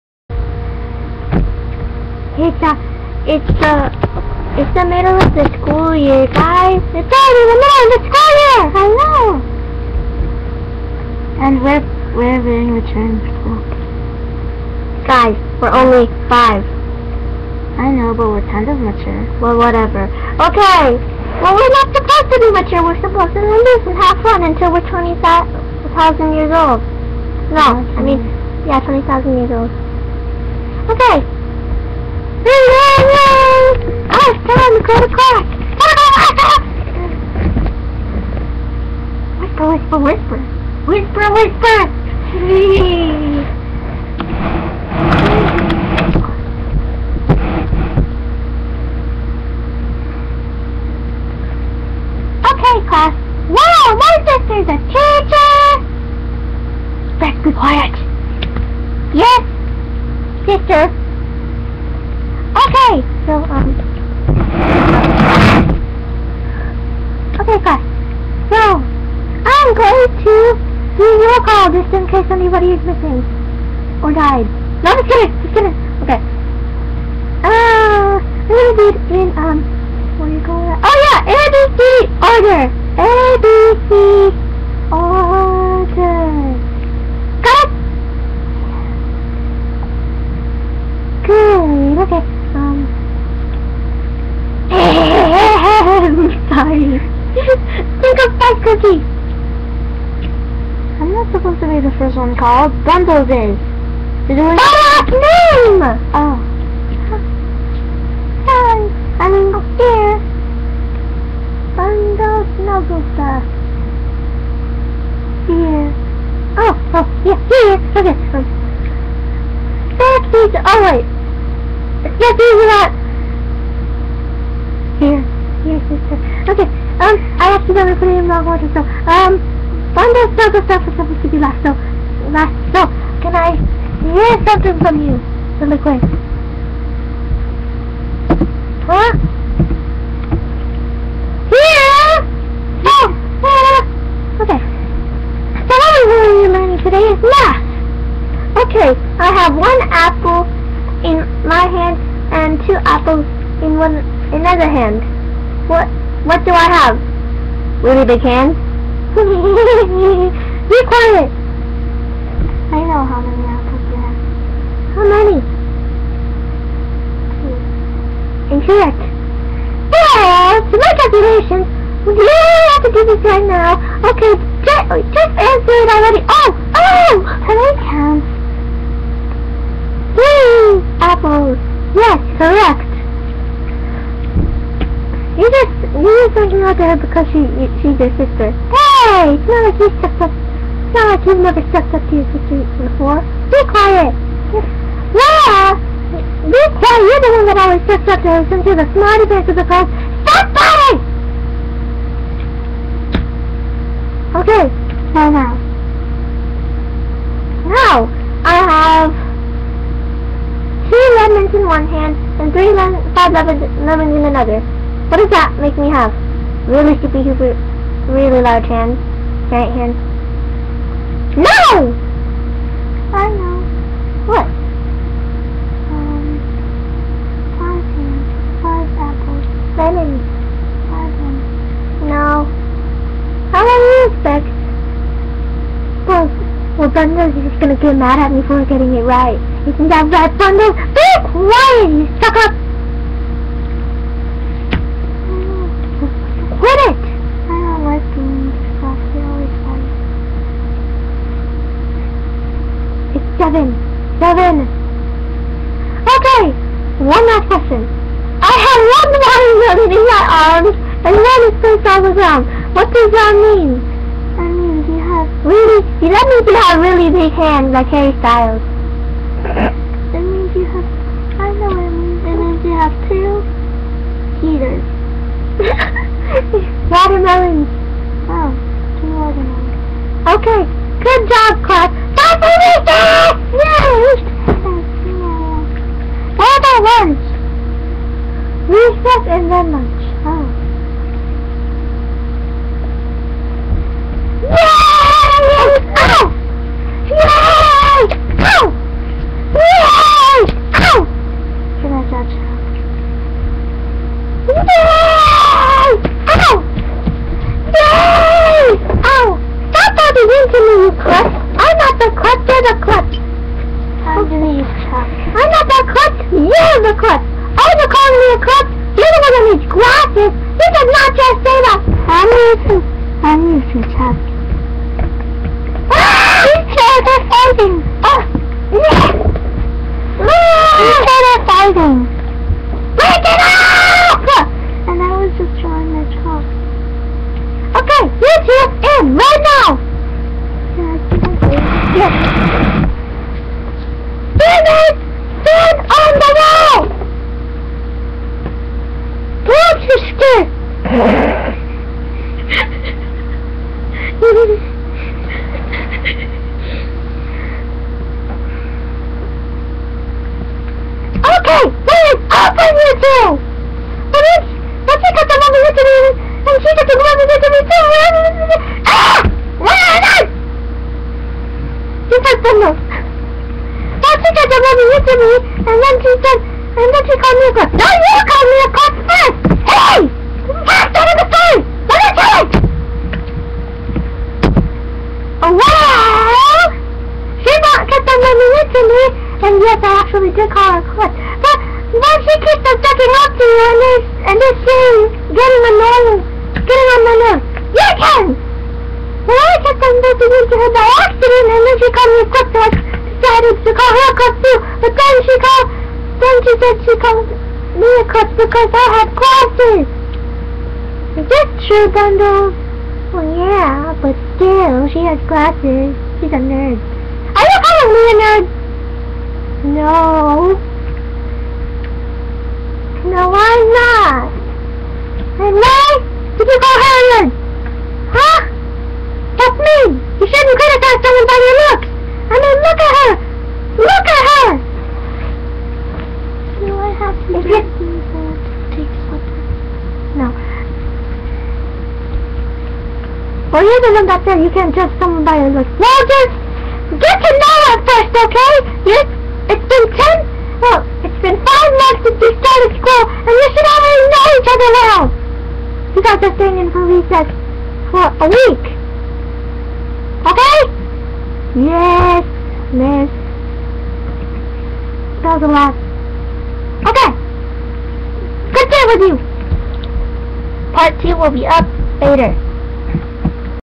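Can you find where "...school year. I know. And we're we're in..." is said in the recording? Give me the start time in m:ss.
0:08.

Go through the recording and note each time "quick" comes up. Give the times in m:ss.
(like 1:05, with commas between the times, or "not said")
2:15, 6:42.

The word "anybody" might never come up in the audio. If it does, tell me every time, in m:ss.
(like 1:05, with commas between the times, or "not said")
1:12.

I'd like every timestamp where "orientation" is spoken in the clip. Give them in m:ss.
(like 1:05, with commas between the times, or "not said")
not said.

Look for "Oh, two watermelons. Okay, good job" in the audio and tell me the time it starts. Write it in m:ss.
4:38.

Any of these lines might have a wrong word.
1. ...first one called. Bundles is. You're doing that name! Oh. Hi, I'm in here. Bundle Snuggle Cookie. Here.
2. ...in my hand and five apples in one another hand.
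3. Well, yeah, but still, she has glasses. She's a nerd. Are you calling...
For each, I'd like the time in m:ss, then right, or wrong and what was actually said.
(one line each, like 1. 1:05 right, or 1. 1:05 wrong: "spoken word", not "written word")
1. 1:41 wrong: "Stuff", not "Cookie"
2. 2:31 wrong: "two", not "five"
3. 6:53 right.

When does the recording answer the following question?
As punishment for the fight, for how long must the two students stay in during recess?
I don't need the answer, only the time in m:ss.
7:38.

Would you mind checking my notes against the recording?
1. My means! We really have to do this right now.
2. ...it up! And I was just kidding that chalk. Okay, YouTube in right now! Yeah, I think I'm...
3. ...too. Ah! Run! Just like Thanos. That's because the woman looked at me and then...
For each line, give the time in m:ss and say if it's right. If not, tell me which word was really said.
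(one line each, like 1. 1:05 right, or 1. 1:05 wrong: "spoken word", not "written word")
1. 2:50 wrong: "calculations", not "means"
2. 5:33 wrong: "drawing", not "kidding"
3. 6:07 right.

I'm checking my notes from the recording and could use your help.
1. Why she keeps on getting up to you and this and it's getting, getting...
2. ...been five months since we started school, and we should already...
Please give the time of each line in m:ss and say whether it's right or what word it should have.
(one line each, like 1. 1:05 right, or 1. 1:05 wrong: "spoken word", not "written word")
1. 6:32 right
2. 7:31 right.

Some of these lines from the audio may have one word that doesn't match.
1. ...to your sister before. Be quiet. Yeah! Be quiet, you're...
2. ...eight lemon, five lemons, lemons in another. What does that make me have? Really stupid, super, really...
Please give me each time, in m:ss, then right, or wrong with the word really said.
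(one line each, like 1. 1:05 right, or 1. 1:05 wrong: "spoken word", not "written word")
1. 3:12 right
2. 3:32 wrong: "three", not "eight".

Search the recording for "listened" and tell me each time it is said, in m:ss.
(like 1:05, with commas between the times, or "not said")
not said.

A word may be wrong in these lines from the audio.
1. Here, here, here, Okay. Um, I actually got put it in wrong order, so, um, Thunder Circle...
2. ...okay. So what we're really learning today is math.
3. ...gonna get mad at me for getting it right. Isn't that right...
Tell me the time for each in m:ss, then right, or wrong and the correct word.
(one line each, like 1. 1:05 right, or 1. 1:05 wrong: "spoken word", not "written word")
1. 2:04 right
2. 2:24 right
3. 3:57 right.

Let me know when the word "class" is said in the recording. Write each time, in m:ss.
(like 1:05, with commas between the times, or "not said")
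0:35, 0:52, 3:19.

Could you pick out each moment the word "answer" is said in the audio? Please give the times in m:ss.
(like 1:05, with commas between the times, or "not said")
2:55.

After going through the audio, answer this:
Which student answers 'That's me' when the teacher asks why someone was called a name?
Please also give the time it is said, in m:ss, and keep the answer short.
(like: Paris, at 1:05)
Harriet, at 7:06.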